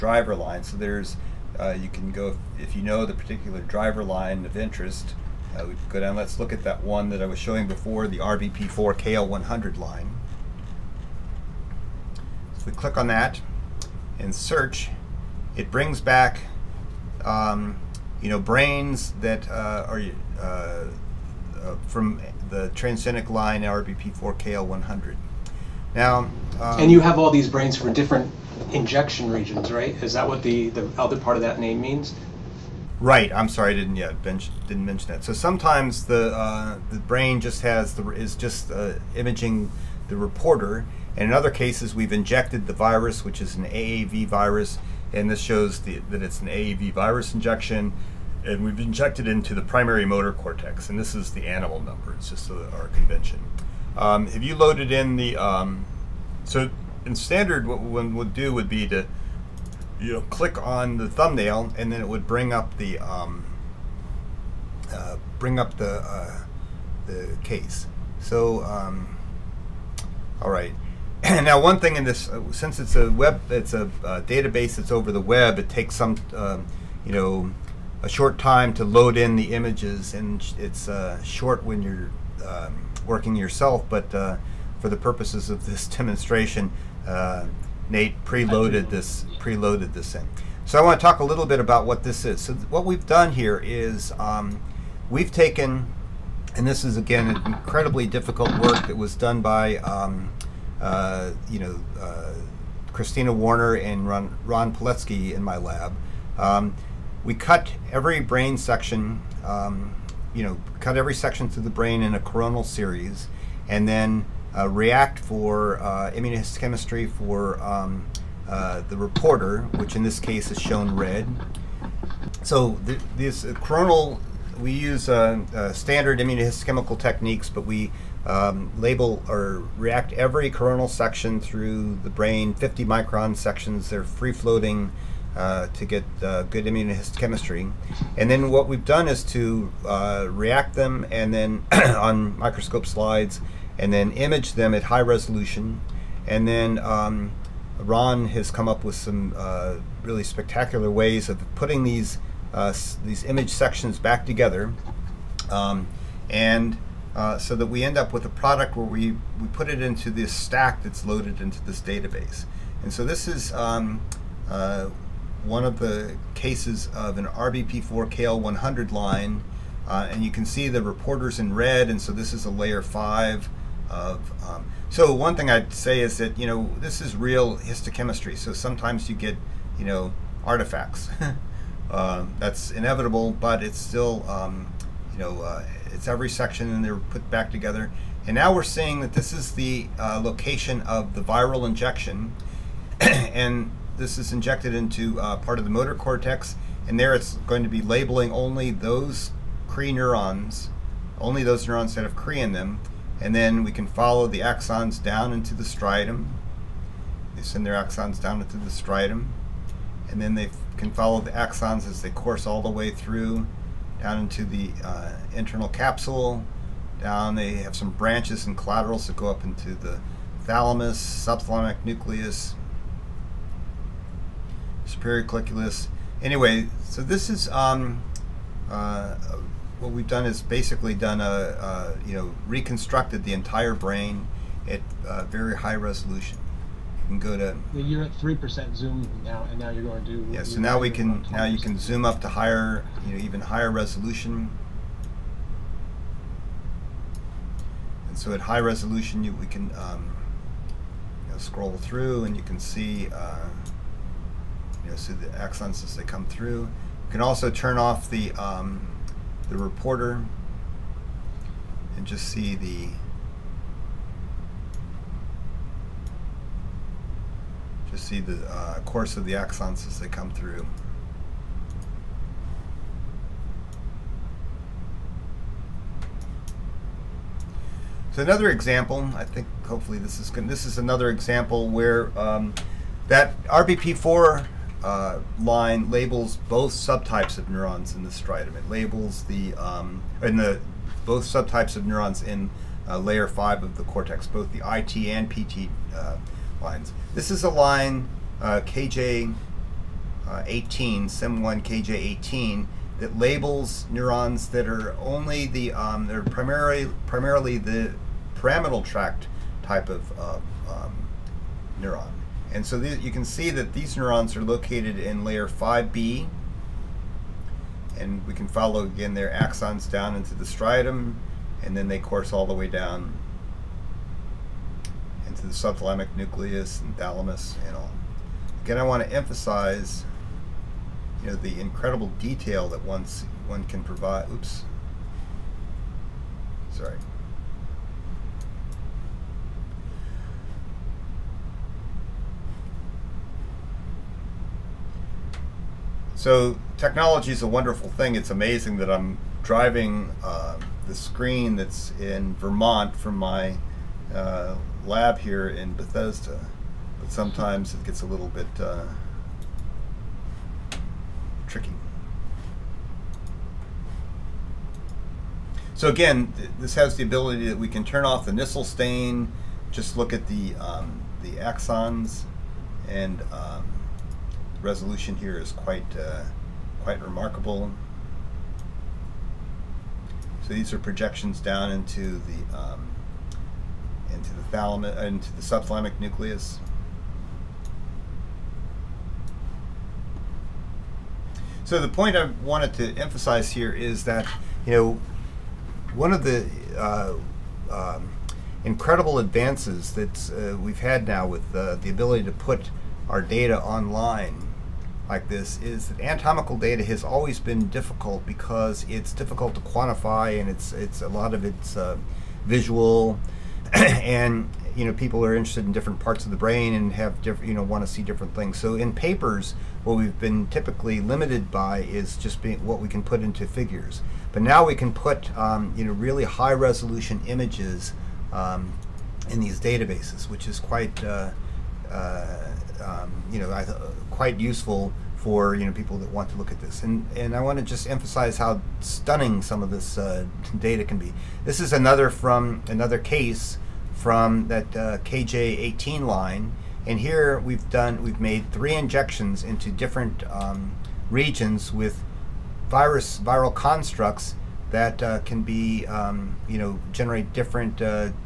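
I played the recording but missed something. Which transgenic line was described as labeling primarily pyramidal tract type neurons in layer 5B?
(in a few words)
SIM1 KJ18.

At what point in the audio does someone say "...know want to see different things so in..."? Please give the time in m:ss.
6:57.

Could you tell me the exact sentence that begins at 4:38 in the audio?
So another example, I think hopefully this is good.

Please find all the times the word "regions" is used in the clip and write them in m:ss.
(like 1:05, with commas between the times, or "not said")
0:29, 7:31.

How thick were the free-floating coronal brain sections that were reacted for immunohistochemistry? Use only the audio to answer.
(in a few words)
50 microns.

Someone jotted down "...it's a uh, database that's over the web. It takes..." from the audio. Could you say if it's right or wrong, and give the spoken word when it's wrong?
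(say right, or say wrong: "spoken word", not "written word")
right.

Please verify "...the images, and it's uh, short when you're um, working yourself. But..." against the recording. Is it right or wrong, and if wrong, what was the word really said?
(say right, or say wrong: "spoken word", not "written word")
right.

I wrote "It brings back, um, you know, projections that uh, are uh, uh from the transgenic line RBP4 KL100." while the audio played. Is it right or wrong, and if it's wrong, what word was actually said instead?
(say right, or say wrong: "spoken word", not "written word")
wrong: "brains", not "projections".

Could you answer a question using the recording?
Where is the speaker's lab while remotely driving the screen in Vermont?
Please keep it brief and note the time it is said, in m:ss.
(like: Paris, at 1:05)
Bethesda, at 5:55.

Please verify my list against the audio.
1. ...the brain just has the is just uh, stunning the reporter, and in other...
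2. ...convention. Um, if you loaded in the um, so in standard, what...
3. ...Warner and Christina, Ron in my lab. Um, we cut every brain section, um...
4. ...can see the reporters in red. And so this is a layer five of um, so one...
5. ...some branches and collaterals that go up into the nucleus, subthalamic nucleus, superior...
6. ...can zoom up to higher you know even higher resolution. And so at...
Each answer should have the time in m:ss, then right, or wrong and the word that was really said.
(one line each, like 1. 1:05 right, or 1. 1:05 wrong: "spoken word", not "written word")
1. 0:36 wrong: "imaging", not "stunning"
2. 0:52 right
3. 1:43 wrong: "Ron", not "Christina"
4. 2:50 right
5. 3:37 wrong: "thalamus", not "nucleus"
6. 4:01 right.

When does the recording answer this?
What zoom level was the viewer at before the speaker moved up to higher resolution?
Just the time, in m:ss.
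3:58.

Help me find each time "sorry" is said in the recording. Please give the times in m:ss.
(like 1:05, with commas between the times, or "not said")
0:33, 5:36.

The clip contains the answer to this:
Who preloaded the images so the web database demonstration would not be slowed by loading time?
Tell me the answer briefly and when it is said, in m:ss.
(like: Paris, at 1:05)
Nate, at 1:27.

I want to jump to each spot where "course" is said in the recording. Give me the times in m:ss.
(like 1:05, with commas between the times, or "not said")
3:32, 4:28, 5:21.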